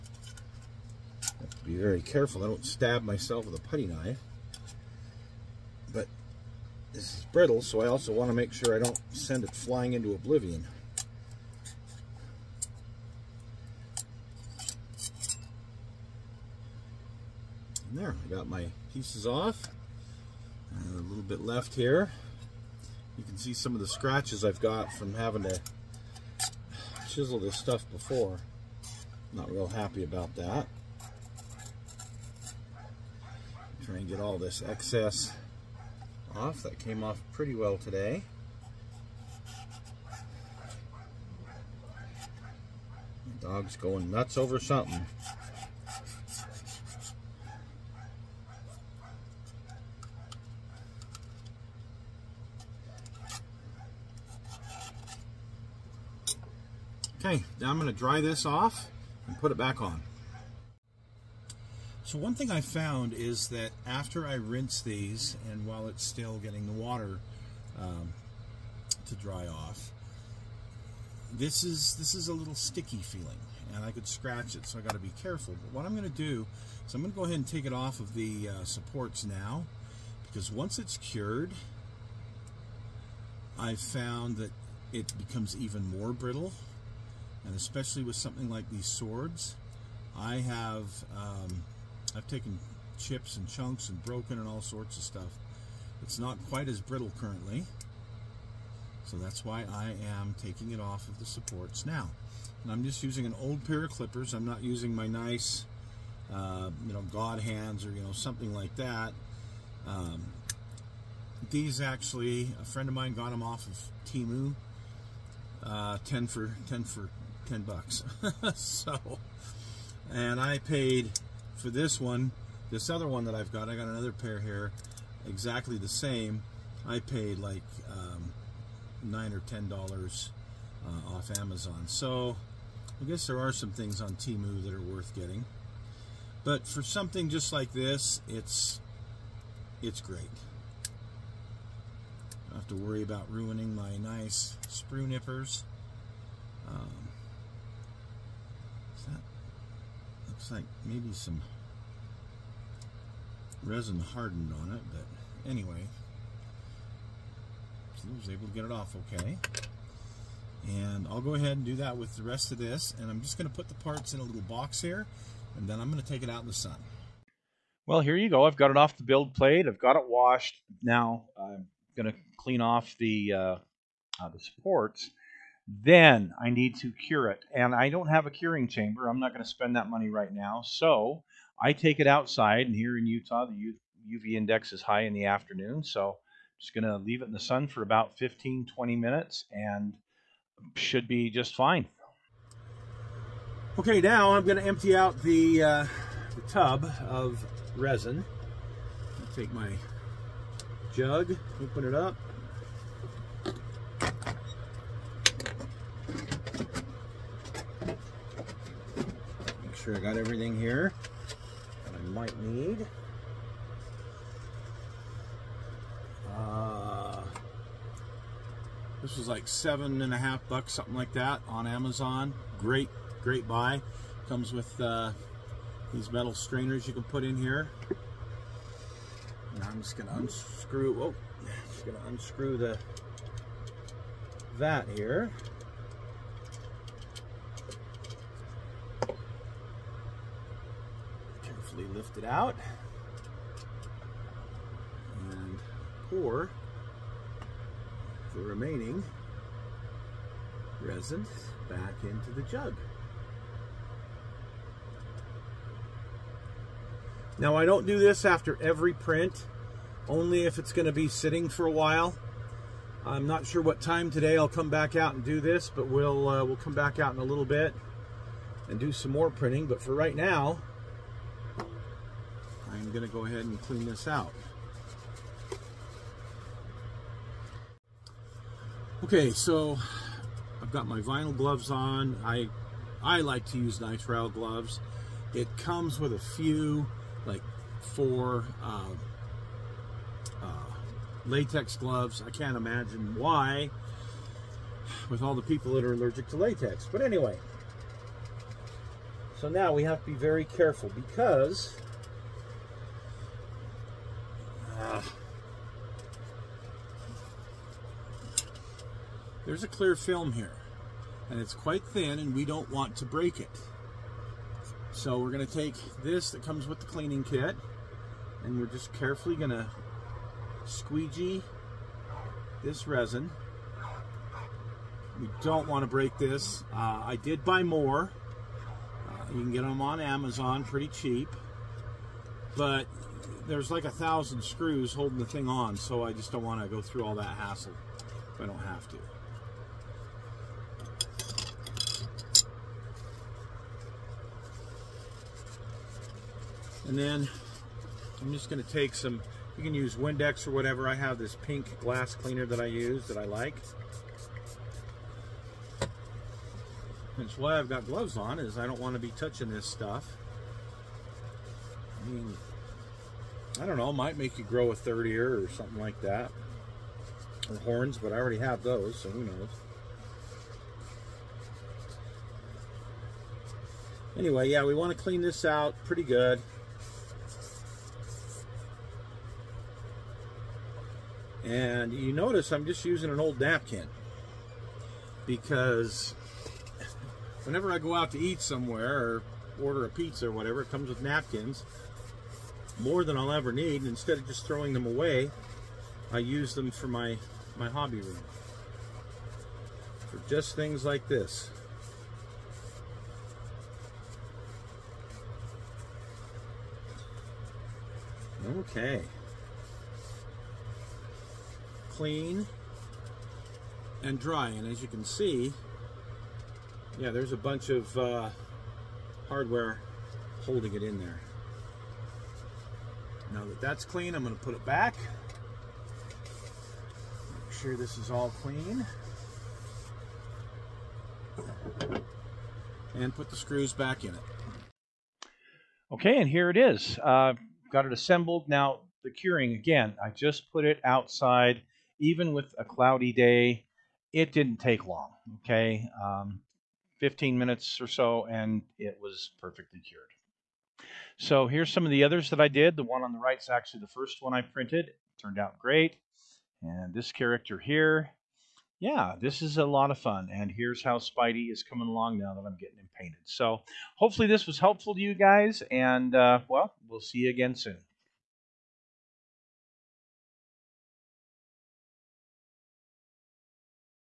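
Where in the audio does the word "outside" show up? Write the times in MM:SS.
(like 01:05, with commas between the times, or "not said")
03:02, 07:20.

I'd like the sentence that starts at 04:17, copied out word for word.
Now I don't do this after every print, only if it's going to be sitting for a while.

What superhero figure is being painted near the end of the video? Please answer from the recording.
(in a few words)
Spidey.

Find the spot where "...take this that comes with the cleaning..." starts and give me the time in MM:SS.
05:15.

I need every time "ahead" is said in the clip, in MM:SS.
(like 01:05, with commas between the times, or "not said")
01:17, 02:41, 04:33.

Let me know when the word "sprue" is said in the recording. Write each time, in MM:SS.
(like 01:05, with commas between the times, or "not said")
02:24.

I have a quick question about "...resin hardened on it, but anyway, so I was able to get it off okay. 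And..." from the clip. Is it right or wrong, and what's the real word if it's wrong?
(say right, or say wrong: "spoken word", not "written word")
right.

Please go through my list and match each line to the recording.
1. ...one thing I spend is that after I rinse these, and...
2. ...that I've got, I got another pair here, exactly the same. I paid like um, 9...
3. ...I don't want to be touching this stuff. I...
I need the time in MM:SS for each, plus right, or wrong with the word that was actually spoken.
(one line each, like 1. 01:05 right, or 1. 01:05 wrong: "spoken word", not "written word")
1. 01:02 wrong: "found", not "spend"
2. 02:03 right
3. 05:58 right.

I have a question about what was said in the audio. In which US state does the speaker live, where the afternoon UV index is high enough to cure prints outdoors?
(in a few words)
Utah.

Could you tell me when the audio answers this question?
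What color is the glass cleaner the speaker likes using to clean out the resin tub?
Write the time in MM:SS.
05:51.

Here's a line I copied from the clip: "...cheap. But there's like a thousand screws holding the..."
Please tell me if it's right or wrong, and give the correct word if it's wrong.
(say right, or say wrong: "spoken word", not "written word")
right.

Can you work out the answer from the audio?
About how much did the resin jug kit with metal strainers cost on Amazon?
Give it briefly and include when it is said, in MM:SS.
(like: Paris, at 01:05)
$7.50, at 03:39.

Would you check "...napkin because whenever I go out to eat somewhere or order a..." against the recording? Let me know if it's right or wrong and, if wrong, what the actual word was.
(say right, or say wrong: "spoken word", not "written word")
right.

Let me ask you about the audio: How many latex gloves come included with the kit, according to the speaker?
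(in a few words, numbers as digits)
4.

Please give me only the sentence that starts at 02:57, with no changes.
And I don't have a curing chamber.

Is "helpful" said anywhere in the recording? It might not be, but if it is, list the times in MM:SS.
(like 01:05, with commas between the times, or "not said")
07:44.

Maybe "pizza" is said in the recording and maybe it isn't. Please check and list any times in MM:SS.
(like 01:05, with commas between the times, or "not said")
06:29.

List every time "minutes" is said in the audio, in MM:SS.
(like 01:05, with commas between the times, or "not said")
03:08, 07:27.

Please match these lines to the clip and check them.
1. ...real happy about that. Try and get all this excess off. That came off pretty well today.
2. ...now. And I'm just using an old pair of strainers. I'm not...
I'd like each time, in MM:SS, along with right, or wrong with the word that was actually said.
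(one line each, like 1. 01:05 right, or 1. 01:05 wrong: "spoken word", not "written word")
1. 00:29 right
2. 01:41 wrong: "clippers", not "strainers".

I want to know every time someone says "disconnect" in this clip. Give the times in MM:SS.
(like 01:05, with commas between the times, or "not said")
not said.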